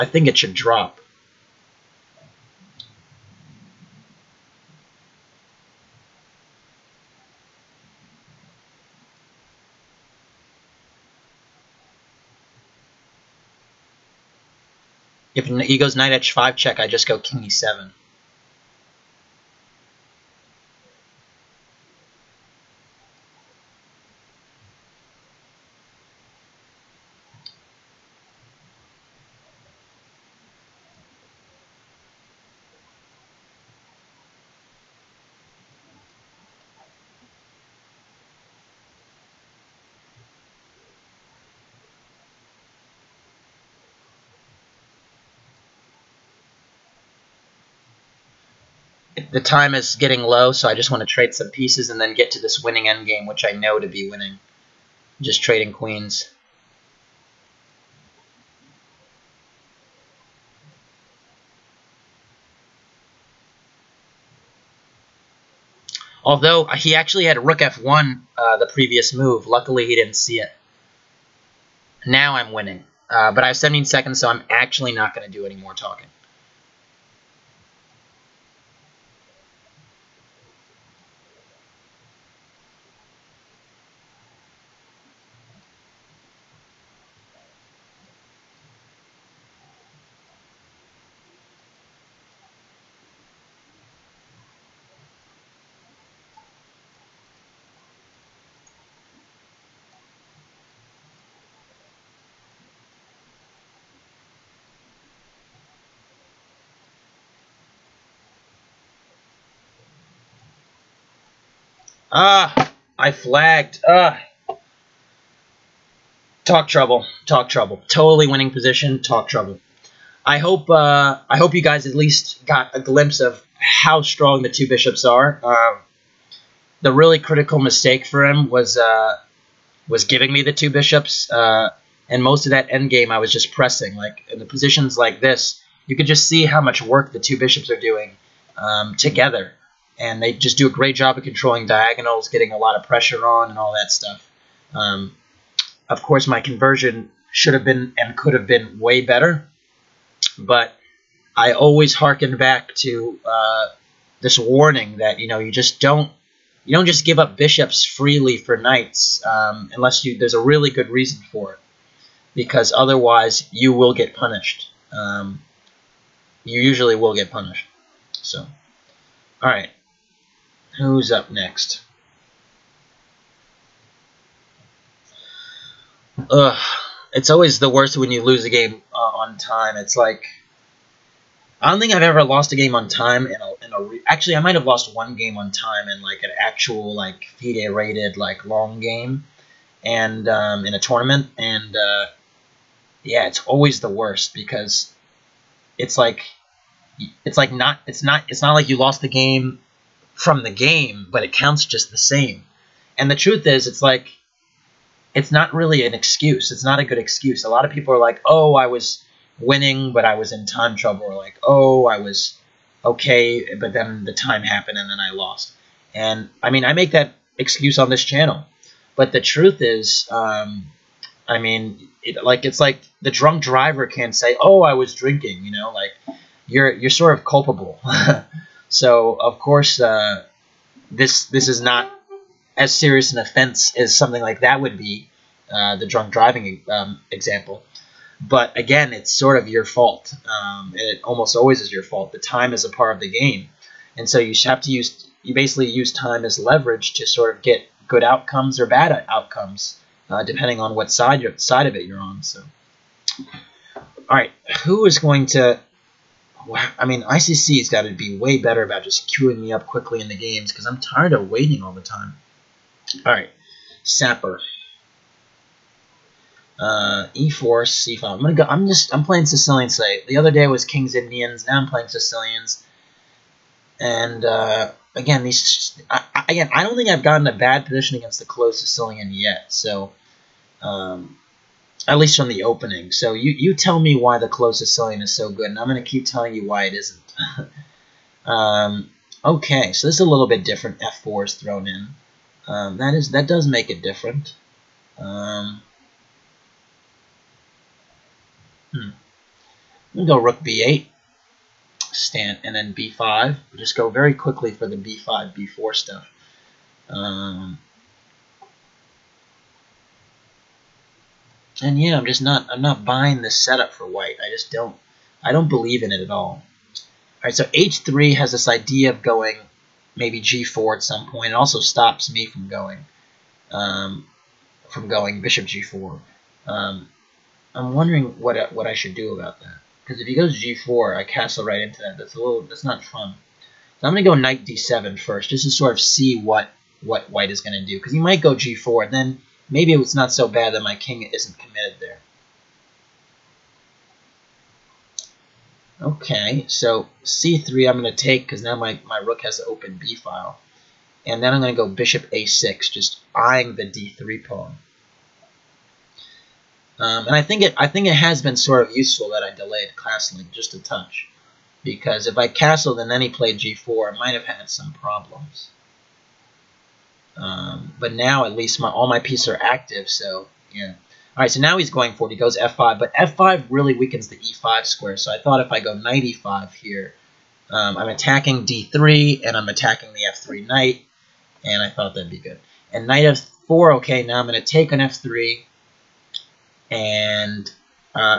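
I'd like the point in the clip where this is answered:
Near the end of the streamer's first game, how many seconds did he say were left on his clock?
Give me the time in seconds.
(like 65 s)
73 s.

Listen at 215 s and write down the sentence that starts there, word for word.
And I mean, I make that excuse on this channel.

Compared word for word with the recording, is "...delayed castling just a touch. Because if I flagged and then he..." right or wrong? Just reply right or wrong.
wrong.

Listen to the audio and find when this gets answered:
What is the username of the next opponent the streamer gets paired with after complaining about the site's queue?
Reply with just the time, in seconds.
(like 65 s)
263 s.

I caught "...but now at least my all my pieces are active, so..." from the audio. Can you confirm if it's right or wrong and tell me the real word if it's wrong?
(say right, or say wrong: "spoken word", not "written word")
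right.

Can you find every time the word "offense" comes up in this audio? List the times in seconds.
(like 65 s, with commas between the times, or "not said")
233 s.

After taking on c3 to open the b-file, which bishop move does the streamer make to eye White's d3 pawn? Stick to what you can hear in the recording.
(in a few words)
bishop a6.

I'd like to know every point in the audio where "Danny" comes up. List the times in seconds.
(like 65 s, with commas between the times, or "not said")
not said.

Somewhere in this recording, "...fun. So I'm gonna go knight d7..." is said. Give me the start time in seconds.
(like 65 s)
332 s.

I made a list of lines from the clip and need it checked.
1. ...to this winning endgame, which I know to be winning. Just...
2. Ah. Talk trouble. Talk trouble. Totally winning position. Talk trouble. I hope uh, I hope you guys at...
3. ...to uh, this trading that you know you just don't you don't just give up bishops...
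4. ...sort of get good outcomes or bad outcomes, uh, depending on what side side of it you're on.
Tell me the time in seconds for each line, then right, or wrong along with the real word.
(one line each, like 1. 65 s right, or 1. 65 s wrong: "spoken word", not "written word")
1. 52 s right
2. 113 s right
3. 152 s wrong: "warning", not "trading"
4. 247 s right.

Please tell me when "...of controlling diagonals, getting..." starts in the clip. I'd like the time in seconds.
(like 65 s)
141 s.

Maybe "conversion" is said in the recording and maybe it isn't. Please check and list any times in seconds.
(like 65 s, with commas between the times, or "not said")
146 s.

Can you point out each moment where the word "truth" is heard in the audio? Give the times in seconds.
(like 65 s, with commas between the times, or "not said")
203 s, 219 s.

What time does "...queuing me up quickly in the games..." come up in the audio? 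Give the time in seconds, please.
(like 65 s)
259 s.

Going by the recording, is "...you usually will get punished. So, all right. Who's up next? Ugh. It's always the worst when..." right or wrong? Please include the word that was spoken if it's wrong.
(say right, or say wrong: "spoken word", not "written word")
right.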